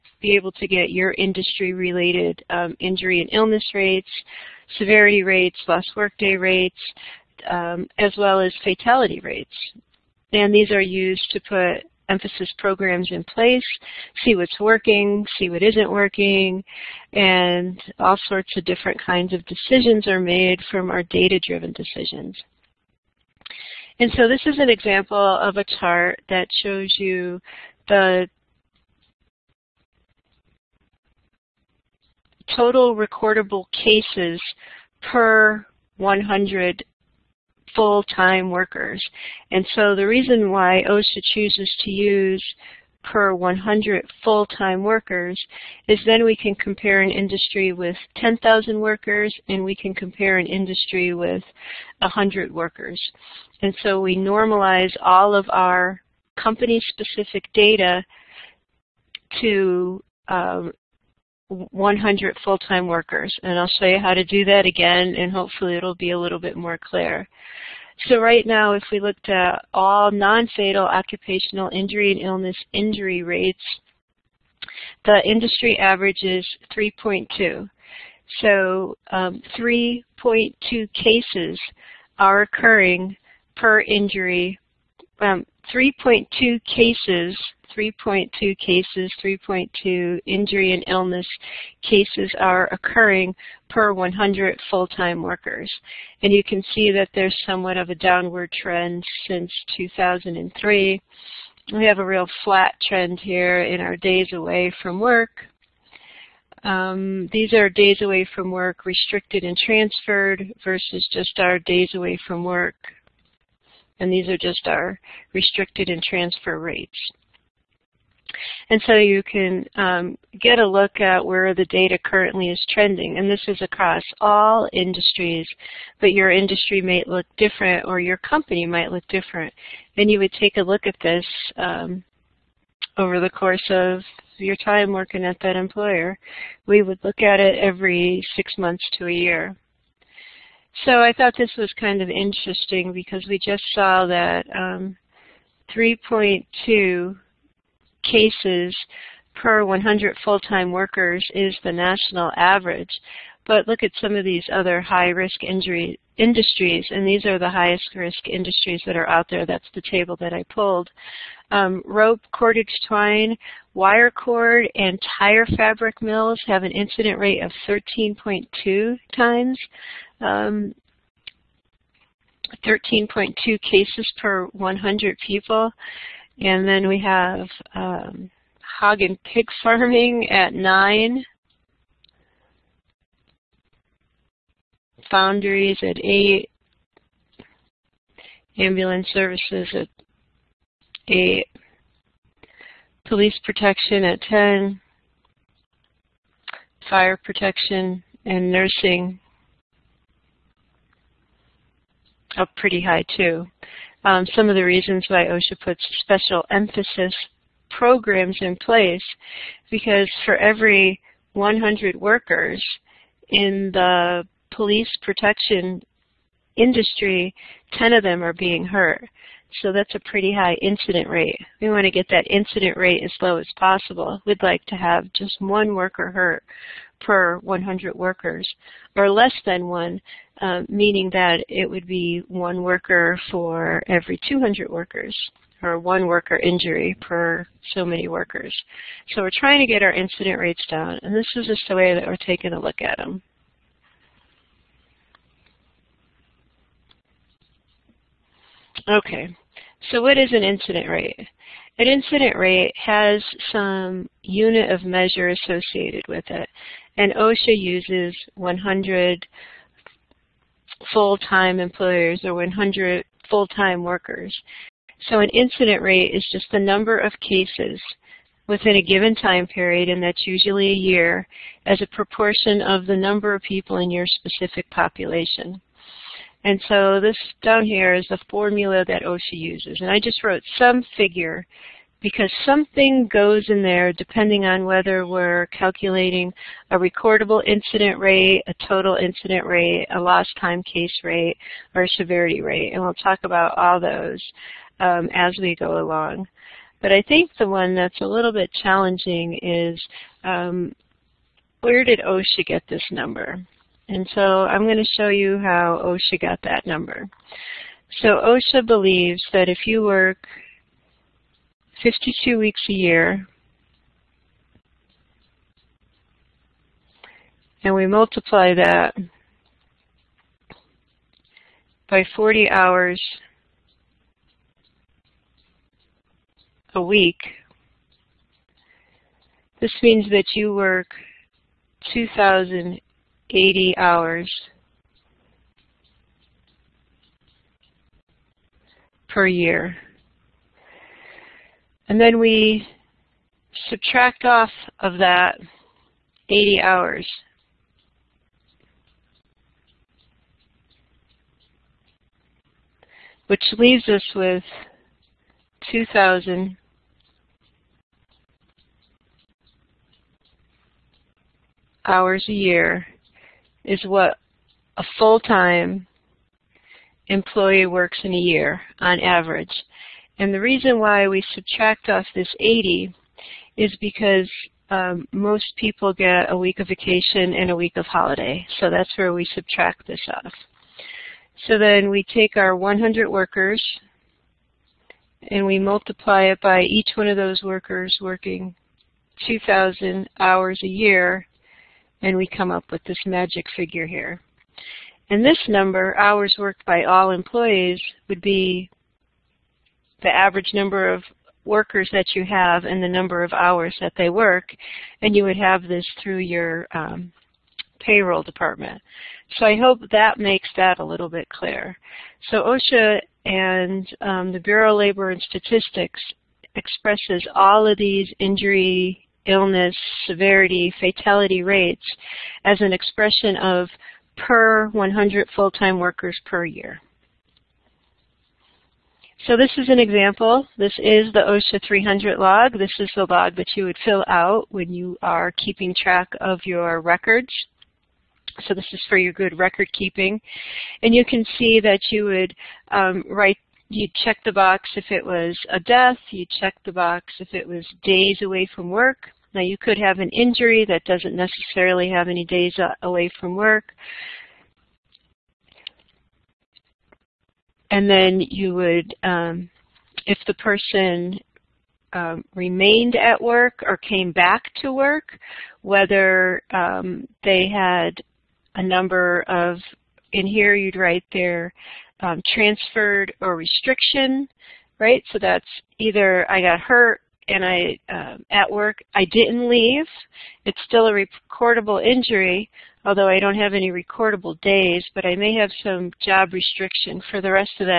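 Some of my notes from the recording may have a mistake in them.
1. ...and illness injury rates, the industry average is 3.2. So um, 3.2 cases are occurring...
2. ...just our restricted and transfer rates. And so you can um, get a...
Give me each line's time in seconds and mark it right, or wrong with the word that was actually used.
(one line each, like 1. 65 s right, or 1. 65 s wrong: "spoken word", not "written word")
1. 72 s right
2. 114 s right.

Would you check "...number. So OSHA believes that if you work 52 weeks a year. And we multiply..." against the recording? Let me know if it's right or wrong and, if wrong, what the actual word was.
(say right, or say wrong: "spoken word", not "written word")
right.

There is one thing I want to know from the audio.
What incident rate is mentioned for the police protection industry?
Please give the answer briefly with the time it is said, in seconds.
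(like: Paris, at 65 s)
10, at 193 s.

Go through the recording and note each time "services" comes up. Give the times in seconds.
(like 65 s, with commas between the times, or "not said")
189 s.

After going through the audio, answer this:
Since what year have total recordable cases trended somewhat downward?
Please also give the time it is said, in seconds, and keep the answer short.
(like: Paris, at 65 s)
2003, at 99 s.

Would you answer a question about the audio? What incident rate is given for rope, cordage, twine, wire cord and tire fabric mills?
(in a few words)
13.2.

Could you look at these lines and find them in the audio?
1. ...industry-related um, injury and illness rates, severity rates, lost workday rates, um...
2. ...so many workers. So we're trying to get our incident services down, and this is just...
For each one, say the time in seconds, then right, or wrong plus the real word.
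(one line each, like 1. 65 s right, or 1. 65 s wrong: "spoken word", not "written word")
1. 1 s right
2. 237 s wrong: "rates", not "services".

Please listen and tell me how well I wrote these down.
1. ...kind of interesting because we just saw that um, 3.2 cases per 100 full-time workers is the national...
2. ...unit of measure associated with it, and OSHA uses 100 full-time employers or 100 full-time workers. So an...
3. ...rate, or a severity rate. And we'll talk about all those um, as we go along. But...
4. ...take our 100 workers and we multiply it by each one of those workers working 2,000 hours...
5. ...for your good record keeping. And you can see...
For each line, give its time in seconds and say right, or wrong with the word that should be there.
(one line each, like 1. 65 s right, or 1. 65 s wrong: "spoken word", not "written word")
1. 141 s right
2. 254 s right
3. 291 s right
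4. 382 s right
5. 438 s right.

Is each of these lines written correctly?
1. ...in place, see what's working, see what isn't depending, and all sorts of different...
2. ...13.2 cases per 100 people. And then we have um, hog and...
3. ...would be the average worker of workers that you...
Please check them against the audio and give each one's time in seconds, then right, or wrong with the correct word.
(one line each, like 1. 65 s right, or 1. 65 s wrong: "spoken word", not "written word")
1. 13 s wrong: "working", not "depending"
2. 172 s right
3. 398 s wrong: "number", not "worker".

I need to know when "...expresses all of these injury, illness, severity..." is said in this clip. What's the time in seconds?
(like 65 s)
416 s.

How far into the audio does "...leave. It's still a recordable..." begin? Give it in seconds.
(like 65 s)
479 s.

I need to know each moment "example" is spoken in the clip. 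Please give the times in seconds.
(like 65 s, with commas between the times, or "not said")
24 s, 429 s.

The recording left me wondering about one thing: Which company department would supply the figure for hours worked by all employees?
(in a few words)
payroll department.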